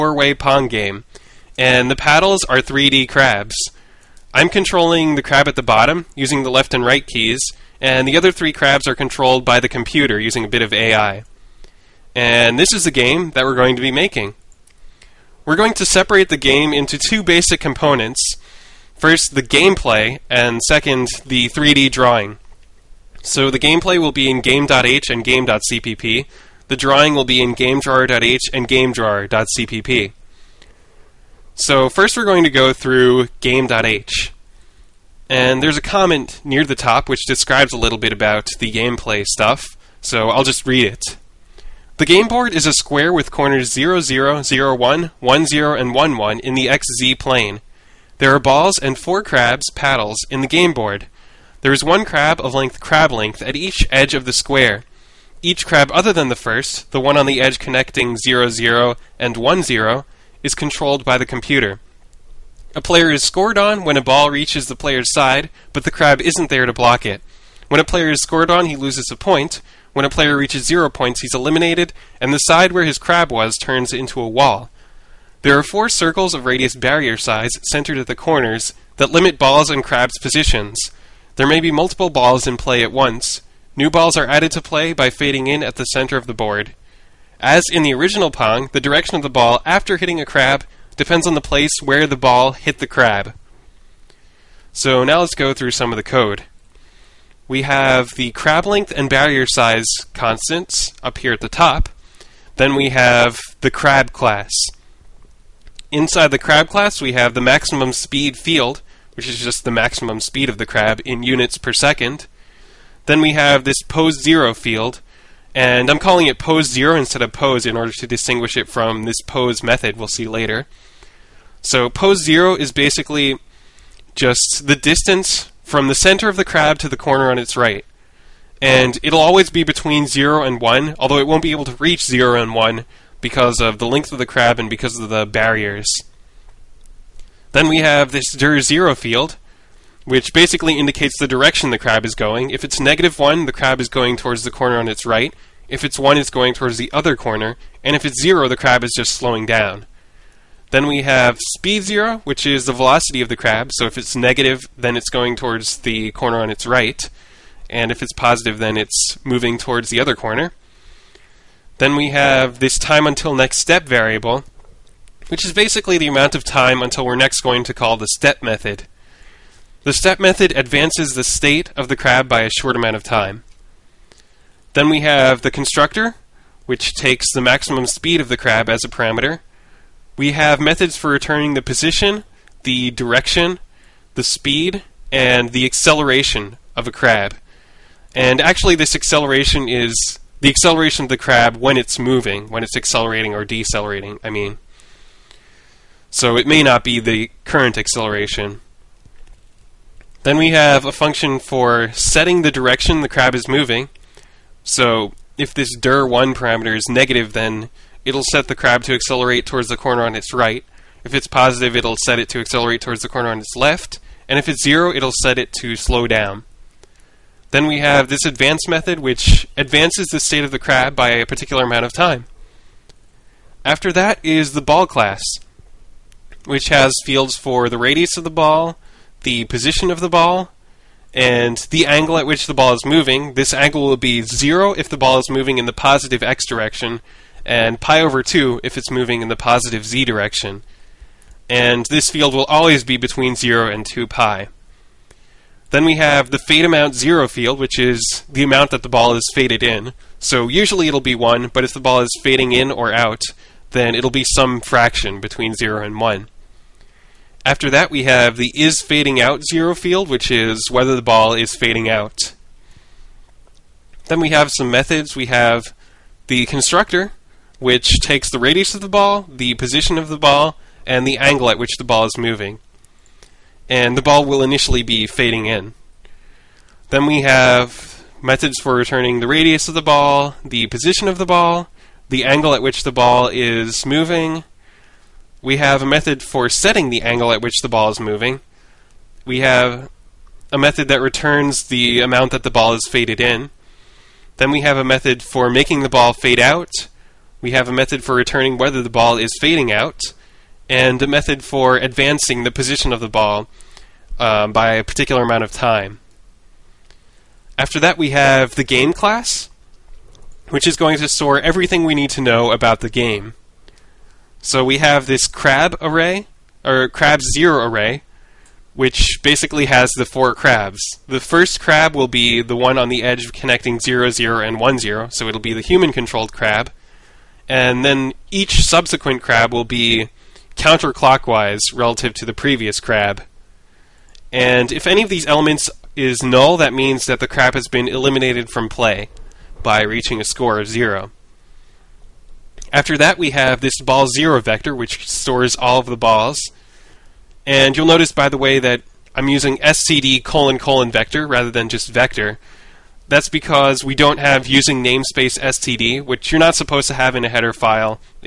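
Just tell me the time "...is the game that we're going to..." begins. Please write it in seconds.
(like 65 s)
12 s.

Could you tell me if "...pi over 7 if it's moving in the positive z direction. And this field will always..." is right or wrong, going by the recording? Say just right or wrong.
wrong.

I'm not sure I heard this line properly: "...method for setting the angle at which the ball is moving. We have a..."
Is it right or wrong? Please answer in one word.
right.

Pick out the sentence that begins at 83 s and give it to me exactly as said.
New balls are added to play by fading in at the center of the board.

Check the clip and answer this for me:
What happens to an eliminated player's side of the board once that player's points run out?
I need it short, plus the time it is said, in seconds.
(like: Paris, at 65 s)
turns into a wall, at 73 s.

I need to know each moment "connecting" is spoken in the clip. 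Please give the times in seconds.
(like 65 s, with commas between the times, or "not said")
57 s, 323 s.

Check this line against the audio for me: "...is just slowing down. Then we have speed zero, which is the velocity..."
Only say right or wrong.
right.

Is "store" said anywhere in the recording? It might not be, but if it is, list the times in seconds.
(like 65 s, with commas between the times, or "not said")
311 s, 345 s.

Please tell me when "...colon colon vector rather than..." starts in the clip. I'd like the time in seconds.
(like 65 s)
350 s.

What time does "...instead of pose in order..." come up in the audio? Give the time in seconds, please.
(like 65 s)
116 s.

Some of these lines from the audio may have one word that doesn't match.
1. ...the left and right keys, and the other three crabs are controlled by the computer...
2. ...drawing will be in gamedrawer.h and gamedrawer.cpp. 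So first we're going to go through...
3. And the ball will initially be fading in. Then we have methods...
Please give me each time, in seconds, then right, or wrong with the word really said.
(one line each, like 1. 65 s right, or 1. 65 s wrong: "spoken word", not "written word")
1. 6 s right
2. 26 s right
3. 273 s right.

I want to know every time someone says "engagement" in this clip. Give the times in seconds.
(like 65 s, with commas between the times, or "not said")
not said.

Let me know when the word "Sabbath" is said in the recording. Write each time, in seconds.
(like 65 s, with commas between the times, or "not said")
not said.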